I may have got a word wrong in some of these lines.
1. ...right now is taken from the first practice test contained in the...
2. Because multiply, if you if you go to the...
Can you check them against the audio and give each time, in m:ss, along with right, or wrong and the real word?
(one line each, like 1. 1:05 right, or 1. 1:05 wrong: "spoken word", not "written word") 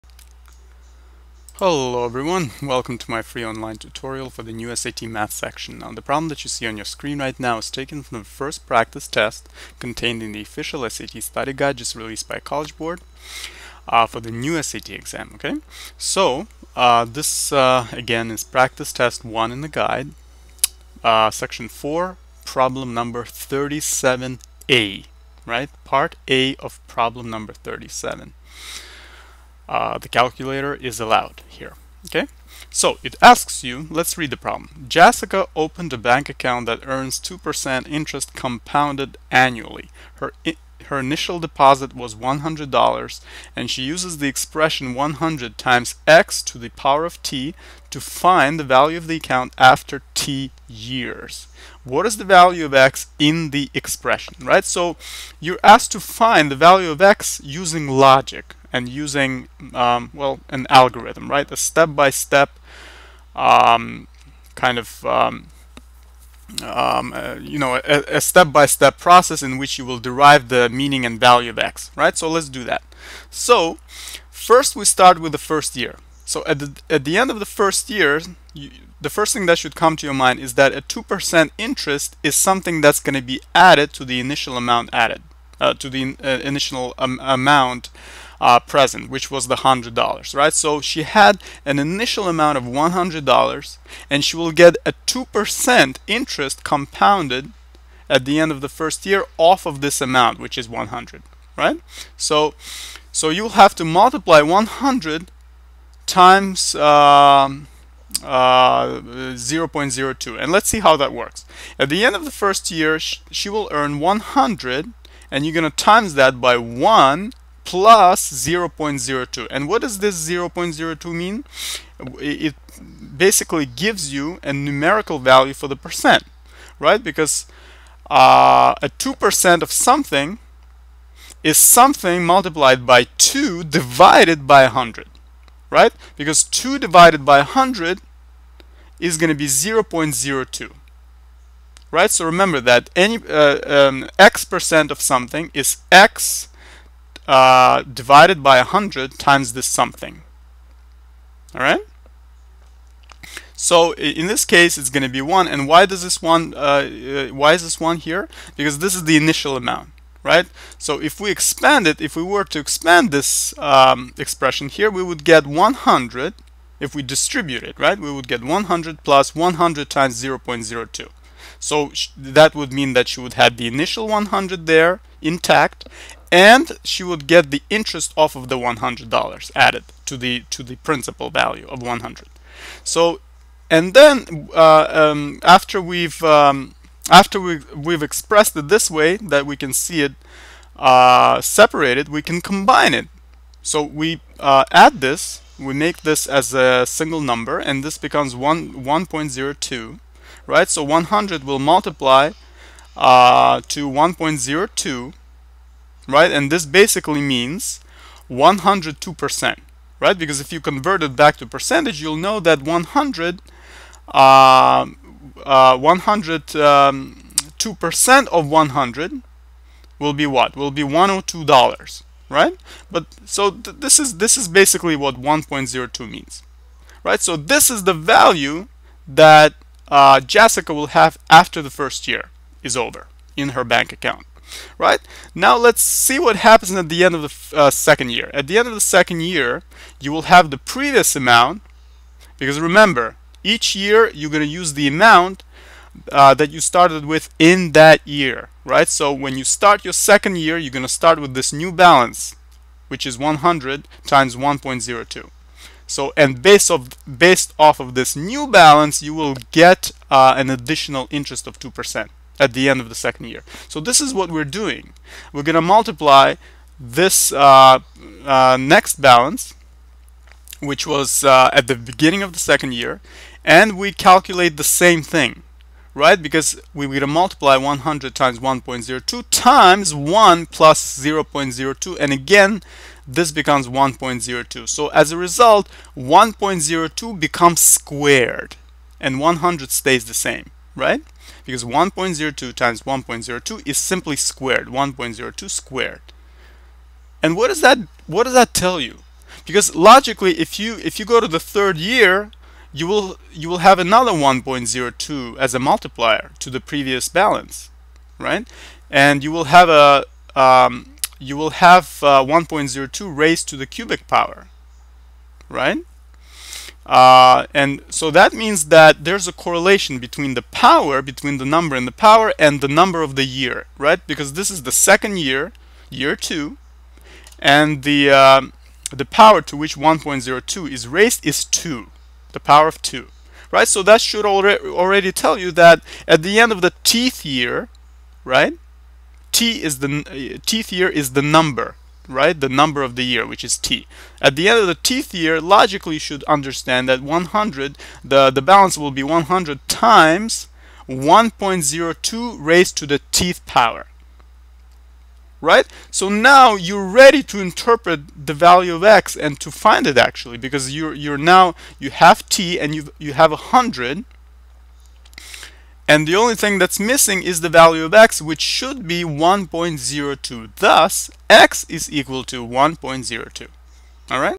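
1. 0:07 right
2. 4:59 wrong: "logically", not "multiply".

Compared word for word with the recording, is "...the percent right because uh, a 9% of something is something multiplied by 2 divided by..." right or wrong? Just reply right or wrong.
wrong.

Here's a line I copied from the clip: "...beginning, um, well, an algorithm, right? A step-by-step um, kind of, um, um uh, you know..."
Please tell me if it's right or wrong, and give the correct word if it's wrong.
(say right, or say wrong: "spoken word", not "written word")
wrong: "using", not "beginning".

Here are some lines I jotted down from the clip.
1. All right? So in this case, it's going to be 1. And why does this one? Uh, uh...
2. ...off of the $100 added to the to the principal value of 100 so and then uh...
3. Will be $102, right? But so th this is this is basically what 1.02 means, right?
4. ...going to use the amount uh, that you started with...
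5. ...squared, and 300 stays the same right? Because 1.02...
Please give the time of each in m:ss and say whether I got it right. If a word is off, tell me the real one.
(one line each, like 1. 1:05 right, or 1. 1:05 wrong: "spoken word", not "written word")
1. 2:31 right
2. 2:58 right
3. 3:40 right
4. 4:04 right
5. 4:47 wrong: "100", not "300".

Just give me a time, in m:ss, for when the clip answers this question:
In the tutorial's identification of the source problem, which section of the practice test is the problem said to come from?
0:21.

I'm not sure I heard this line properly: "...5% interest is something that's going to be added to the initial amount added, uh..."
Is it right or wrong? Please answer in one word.
wrong.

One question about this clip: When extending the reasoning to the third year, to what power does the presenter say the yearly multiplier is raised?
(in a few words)
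cubic power.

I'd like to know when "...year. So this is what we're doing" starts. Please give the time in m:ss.
4:23.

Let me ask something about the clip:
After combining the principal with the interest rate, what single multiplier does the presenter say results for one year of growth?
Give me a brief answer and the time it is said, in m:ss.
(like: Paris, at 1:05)
1.02, at 3:18.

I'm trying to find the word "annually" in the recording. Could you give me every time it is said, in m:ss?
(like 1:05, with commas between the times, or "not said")
0:39.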